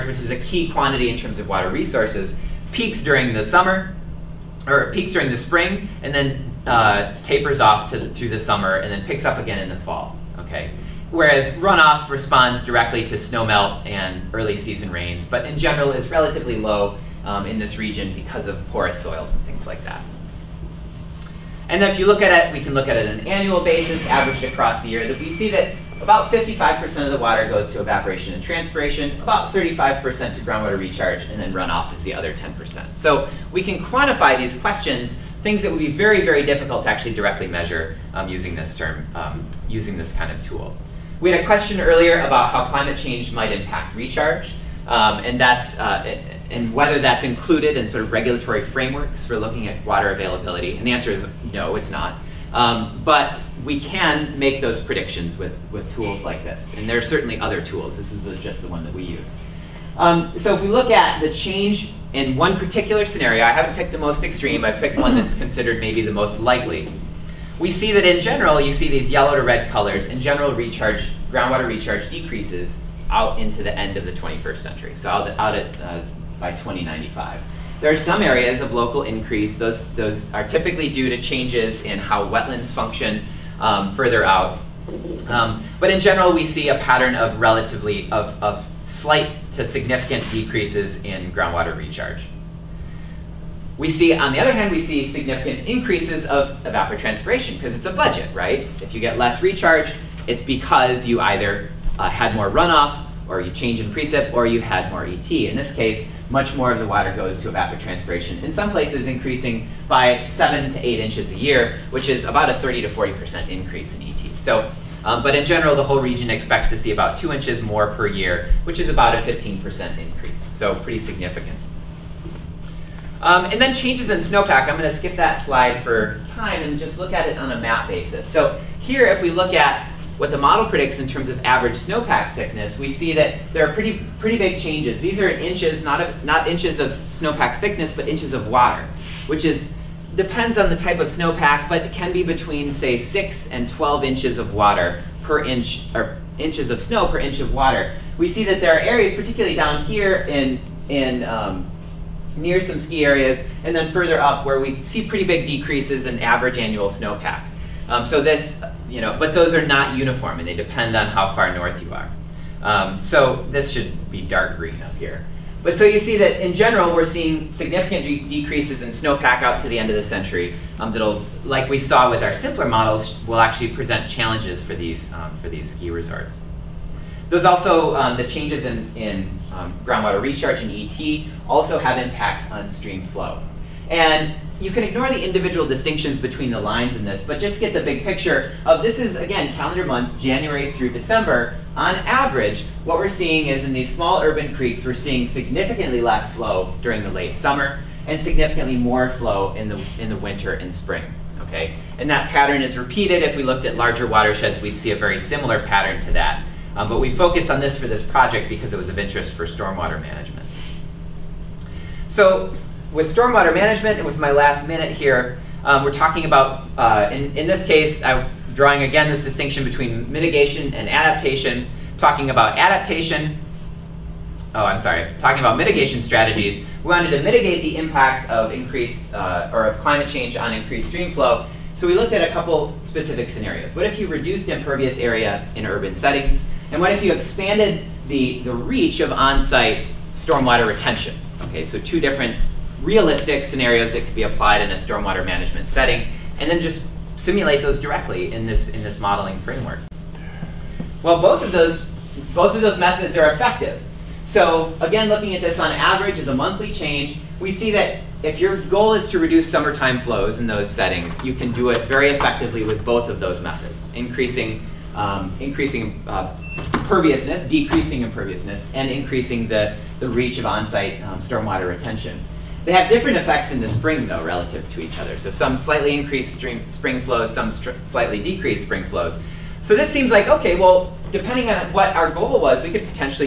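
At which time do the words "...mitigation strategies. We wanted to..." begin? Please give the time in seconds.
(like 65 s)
225 s.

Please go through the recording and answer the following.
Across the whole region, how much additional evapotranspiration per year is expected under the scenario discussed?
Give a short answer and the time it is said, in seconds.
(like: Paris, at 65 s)
2 inches, at 117 s.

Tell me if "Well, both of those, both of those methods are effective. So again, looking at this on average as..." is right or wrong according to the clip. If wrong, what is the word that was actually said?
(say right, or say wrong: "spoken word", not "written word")
right.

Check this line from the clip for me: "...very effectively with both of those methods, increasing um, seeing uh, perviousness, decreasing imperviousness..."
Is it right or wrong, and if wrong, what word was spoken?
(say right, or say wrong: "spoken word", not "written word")
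wrong: "increasing", not "seeing".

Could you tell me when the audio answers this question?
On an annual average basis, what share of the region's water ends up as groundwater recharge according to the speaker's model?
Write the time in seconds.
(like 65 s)
29 s.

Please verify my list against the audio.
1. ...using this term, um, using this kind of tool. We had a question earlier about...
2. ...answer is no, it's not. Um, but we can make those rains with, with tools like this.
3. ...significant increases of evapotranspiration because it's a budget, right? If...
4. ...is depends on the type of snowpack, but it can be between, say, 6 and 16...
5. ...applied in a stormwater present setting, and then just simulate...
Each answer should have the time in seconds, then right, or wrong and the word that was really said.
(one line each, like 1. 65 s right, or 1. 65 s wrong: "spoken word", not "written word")
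1. 38 s right
2. 50 s wrong: "predictions", not "rains"
3. 95 s right
4. 139 s wrong: "12", not "16"
5. 244 s wrong: "management", not "present".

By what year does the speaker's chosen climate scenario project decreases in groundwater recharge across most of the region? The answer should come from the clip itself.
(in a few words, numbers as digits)
2095.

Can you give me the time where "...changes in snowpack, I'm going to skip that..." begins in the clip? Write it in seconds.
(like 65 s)
123 s.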